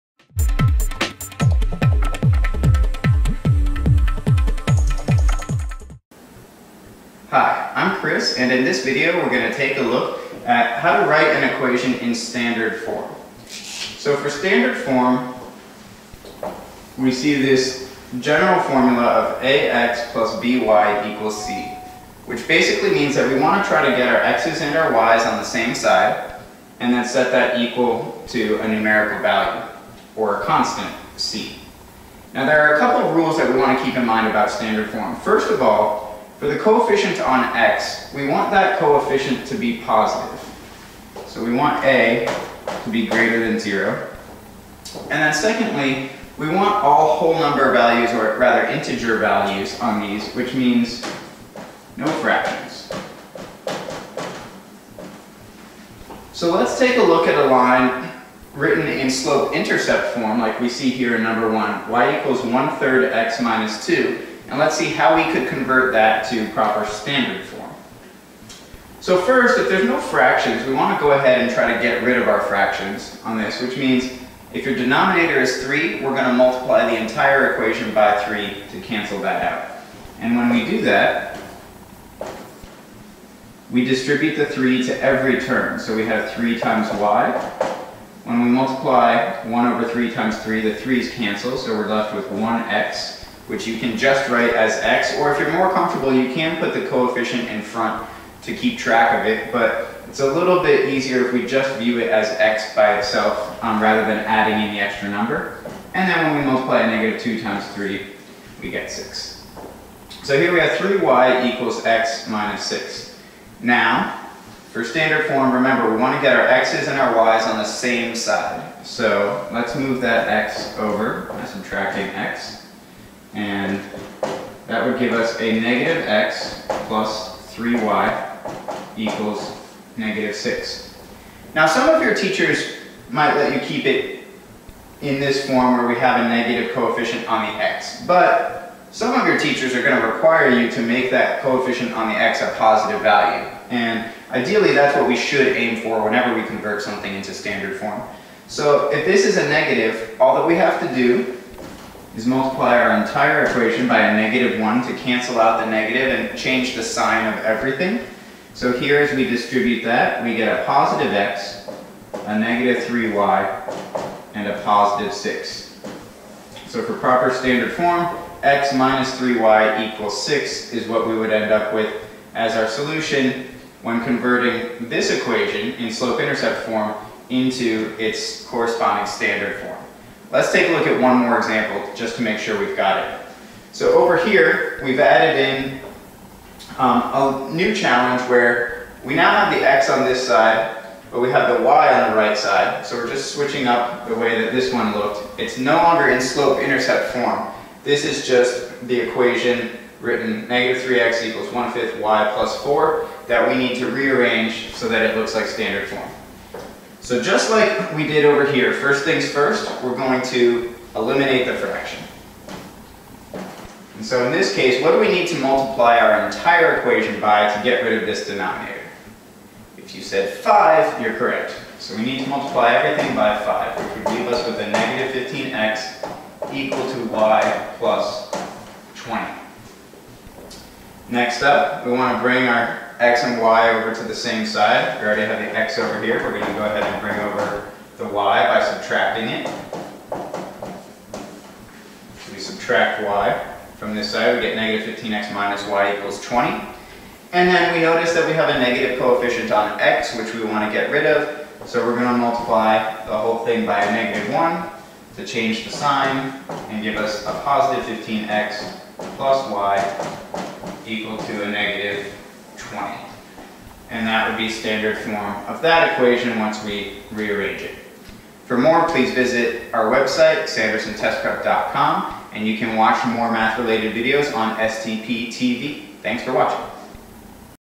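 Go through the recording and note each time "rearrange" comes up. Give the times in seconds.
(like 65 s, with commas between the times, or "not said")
203 s, 267 s.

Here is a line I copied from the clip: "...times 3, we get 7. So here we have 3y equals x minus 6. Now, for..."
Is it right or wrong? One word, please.
wrong.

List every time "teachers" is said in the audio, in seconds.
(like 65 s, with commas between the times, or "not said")
132 s, 139 s.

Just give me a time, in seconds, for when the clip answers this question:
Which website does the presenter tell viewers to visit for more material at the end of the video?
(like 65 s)
270 s.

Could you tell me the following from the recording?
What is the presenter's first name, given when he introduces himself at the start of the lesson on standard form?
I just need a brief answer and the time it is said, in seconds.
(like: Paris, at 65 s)
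Chris, at 8 s.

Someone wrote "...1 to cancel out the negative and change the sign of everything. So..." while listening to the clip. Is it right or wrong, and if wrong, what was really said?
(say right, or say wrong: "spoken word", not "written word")
right.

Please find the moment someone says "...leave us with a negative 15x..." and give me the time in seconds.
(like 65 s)
224 s.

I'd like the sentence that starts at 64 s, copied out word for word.
And let's see how we could convert that to proper standard form.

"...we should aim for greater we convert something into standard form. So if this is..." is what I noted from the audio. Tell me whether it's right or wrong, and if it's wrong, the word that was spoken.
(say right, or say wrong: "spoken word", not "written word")
wrong: "whenever", not "greater".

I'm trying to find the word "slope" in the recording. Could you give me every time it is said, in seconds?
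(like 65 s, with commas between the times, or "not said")
59 s, 175 s, 196 s.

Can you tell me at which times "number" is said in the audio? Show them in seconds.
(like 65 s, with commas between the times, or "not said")
47 s, 61 s, 105 s.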